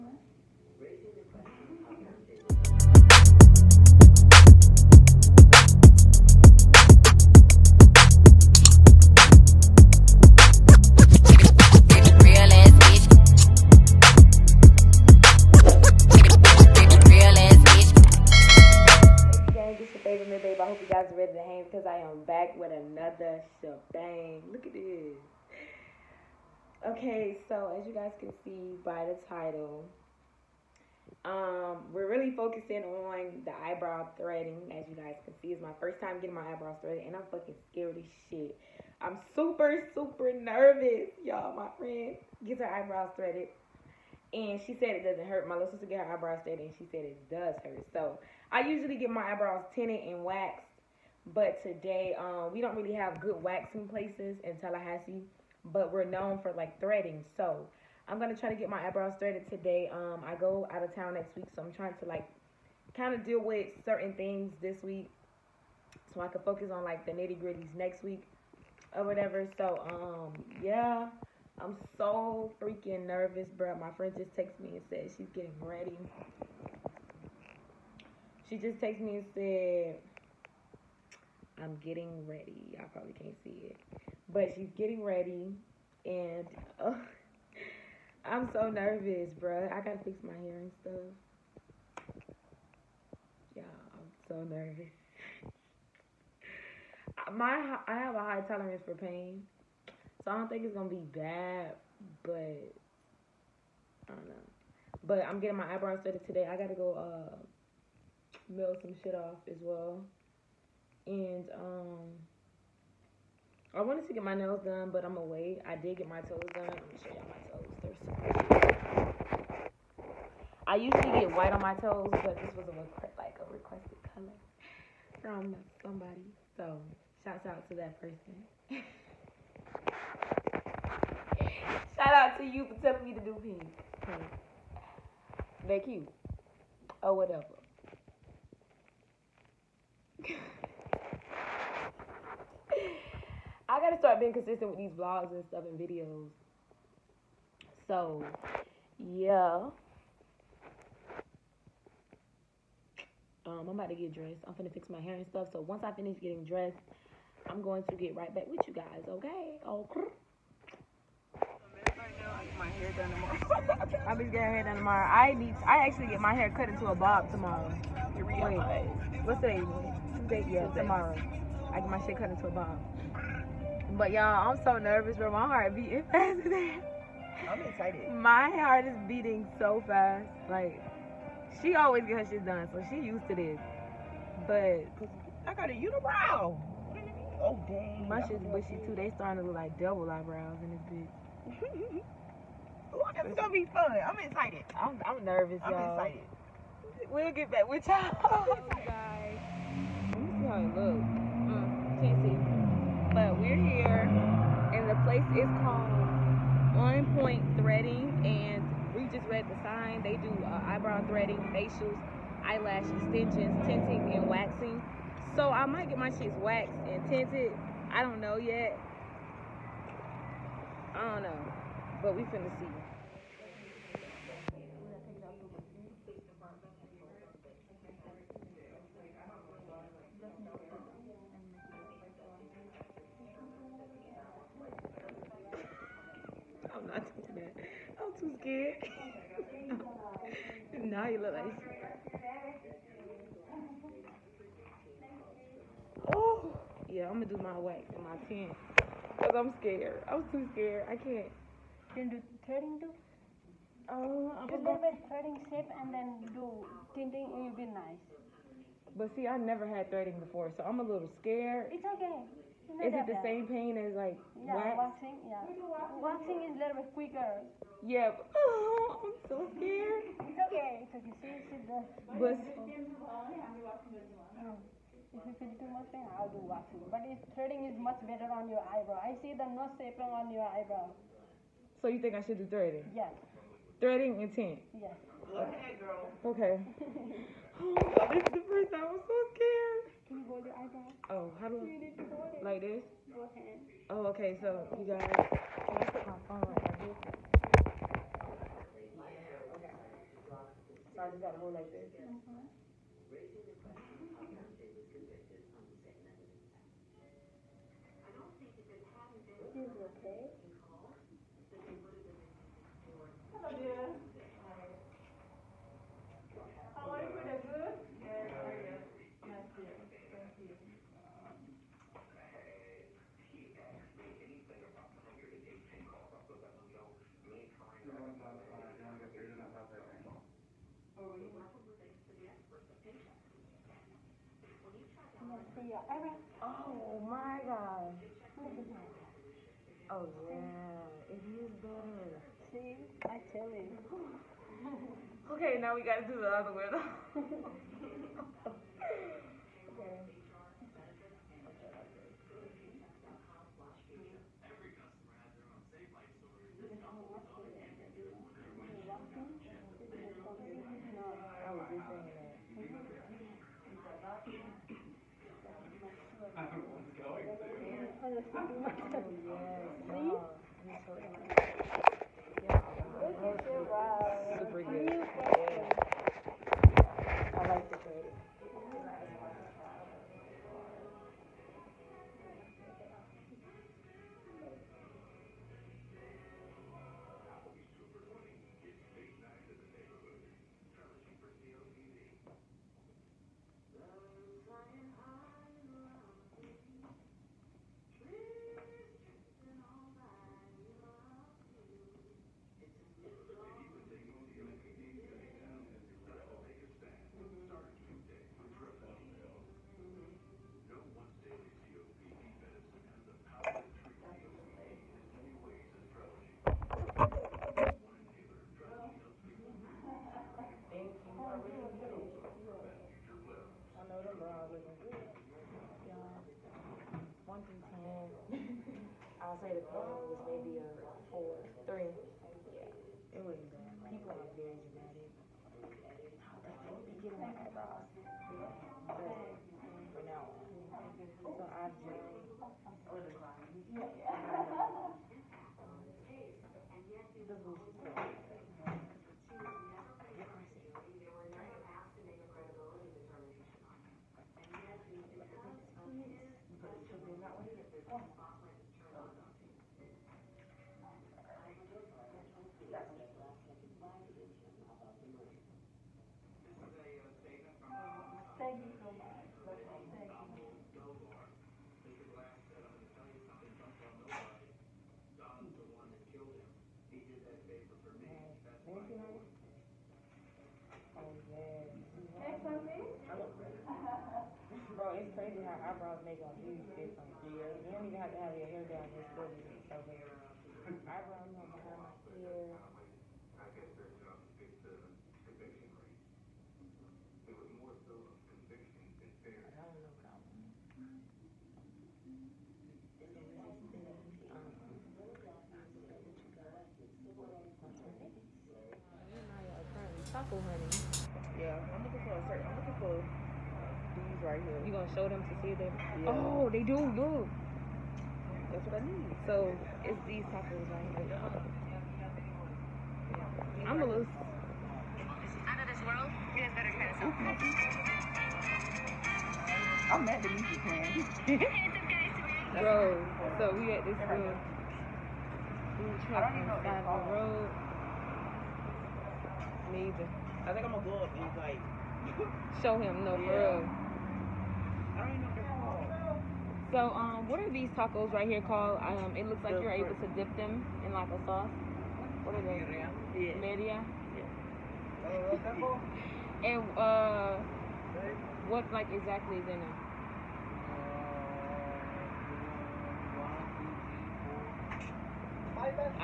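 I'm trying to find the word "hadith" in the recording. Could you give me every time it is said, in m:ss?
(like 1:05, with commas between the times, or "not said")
not said.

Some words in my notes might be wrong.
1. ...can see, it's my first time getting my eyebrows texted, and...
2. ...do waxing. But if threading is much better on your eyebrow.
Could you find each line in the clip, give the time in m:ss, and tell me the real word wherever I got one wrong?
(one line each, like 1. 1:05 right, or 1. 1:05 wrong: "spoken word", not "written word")
1. 0:35 wrong: "threaded", not "texted"
2. 4:36 right.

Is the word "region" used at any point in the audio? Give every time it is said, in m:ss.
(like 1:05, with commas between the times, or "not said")
not said.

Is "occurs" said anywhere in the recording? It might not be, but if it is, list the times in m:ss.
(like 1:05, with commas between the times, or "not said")
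not said.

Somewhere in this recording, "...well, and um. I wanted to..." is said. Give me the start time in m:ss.
1:49.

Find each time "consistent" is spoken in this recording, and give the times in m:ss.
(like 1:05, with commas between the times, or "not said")
2:24.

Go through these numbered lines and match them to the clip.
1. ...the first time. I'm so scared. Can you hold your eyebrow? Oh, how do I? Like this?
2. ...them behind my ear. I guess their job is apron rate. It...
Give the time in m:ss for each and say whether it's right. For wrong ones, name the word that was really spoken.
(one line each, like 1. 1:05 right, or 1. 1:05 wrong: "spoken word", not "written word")
1. 4:48 right
2. 8:11 wrong: "conviction", not "apron".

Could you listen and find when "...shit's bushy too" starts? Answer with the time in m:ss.
3:08.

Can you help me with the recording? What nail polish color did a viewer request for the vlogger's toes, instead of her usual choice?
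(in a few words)
Pink.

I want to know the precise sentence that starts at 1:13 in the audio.
My friend just texted me and said she's getting ready.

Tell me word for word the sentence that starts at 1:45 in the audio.
But I'm getting my eyebrows threaded today.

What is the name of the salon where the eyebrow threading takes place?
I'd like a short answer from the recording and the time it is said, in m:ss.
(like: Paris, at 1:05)
One Point Threading, at 3:26.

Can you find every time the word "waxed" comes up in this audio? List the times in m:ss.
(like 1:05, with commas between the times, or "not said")
0:50, 3:36.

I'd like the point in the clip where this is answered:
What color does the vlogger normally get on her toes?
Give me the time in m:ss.
2:01.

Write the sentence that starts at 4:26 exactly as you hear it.
Waxing is a little bit quicker.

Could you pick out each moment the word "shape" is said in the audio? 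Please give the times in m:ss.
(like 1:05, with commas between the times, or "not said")
4:15.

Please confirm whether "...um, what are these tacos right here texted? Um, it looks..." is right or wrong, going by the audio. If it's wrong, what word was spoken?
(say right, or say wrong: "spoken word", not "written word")
wrong: "called", not "texted".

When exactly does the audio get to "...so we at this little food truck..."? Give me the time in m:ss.
8:53.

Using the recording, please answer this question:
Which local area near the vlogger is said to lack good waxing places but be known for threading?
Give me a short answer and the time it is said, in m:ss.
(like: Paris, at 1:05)
Tallahassee, at 0:54.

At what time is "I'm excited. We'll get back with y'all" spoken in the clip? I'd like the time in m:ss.
3:16.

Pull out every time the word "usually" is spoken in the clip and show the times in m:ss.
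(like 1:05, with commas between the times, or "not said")
0:48, 2:00.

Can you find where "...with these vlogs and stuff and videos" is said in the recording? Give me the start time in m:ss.
2:24.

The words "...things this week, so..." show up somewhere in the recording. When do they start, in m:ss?
1:04.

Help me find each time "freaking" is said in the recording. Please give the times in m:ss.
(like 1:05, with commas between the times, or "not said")
1:12.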